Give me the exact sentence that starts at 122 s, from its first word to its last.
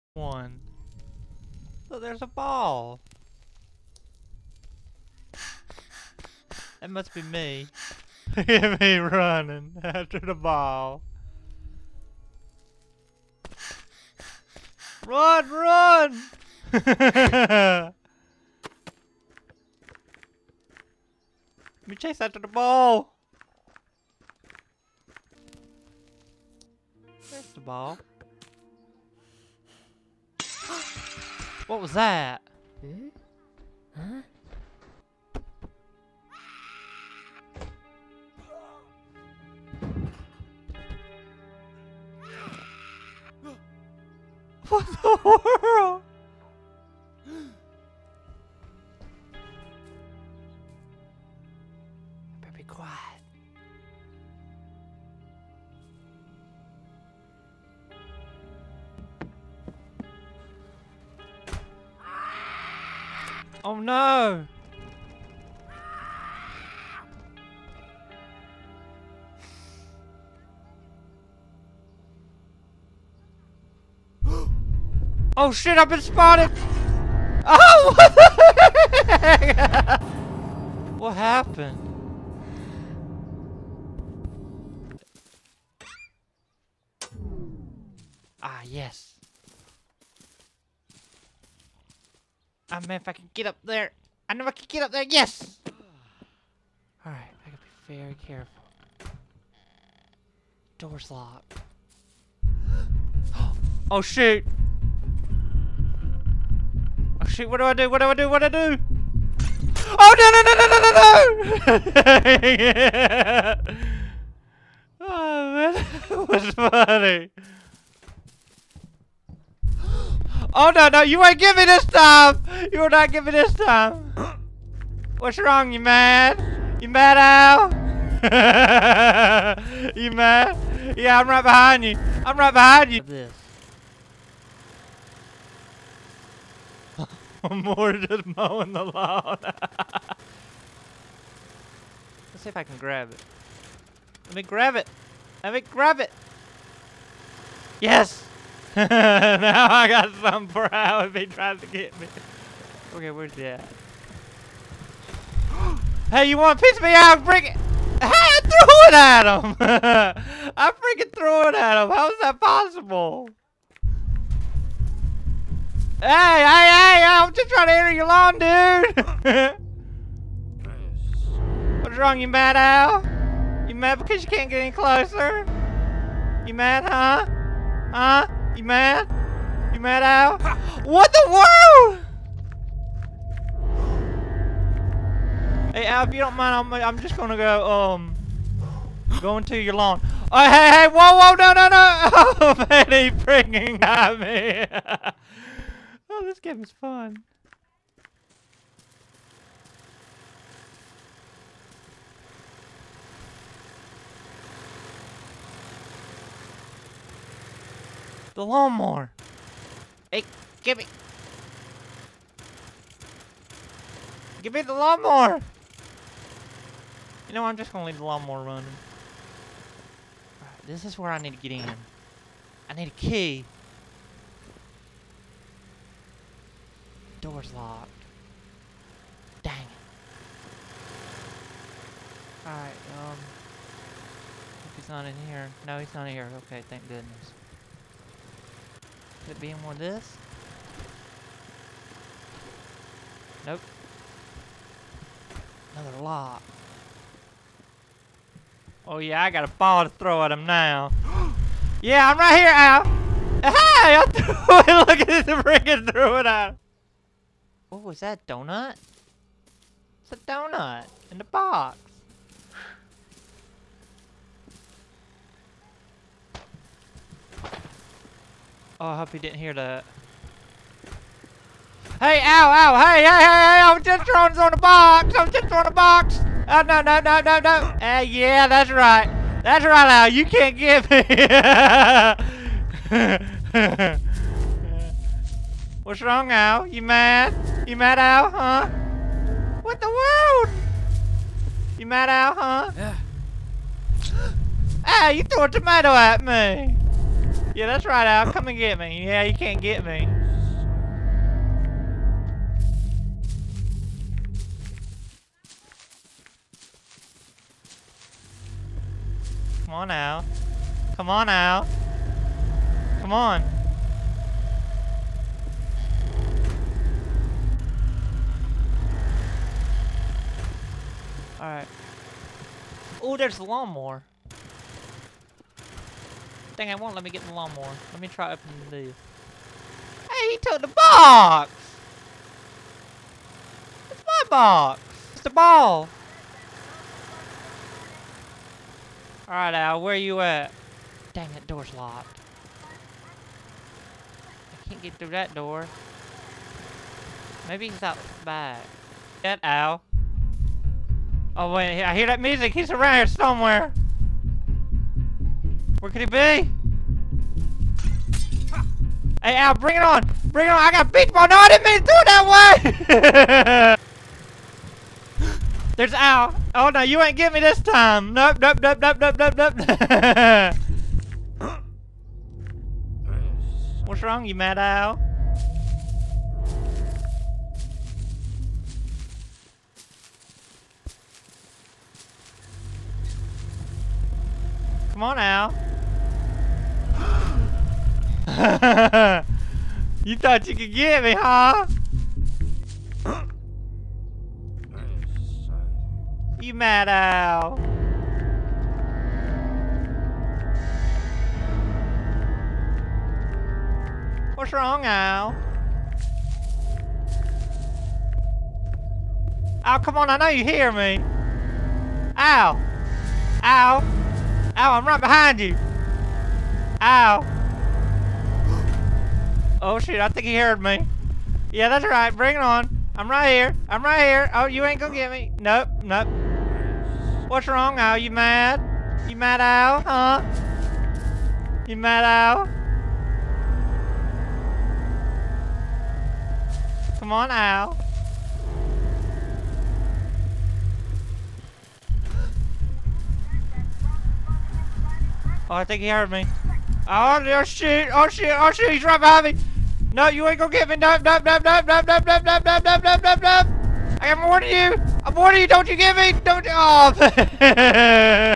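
You are not giving this time!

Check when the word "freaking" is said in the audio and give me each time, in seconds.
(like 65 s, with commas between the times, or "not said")
160 s, 255 s.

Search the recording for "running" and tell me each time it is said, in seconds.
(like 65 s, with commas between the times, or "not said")
8 s, 218 s.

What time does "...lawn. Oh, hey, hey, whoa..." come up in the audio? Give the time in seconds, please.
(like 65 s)
189 s.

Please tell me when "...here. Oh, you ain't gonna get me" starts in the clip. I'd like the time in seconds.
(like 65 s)
424 s.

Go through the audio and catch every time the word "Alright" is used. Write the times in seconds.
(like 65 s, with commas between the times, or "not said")
97 s, 232 s, 321 s, 339 s.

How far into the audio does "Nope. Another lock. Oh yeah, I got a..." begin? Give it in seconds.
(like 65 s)
243 s.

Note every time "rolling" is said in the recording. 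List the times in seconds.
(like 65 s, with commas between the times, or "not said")
not said.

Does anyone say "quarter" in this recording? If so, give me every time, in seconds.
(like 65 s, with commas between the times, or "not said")
not said.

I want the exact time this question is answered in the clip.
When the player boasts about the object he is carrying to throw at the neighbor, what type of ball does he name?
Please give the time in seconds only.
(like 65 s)
360 s.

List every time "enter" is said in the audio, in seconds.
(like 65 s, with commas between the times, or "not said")
167 s.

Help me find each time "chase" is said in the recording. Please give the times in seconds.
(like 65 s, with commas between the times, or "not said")
21 s.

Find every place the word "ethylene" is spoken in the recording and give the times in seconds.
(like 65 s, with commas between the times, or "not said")
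not said.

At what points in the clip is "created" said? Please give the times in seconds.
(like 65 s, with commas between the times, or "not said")
not said.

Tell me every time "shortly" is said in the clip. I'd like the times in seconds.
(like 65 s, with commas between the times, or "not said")
not said.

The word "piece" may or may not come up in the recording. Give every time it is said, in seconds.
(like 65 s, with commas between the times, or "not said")
156 s.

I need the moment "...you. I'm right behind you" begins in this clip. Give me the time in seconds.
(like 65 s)
131 s.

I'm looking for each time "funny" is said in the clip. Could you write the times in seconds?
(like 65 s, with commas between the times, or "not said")
116 s.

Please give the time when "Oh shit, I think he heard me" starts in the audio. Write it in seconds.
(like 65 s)
419 s.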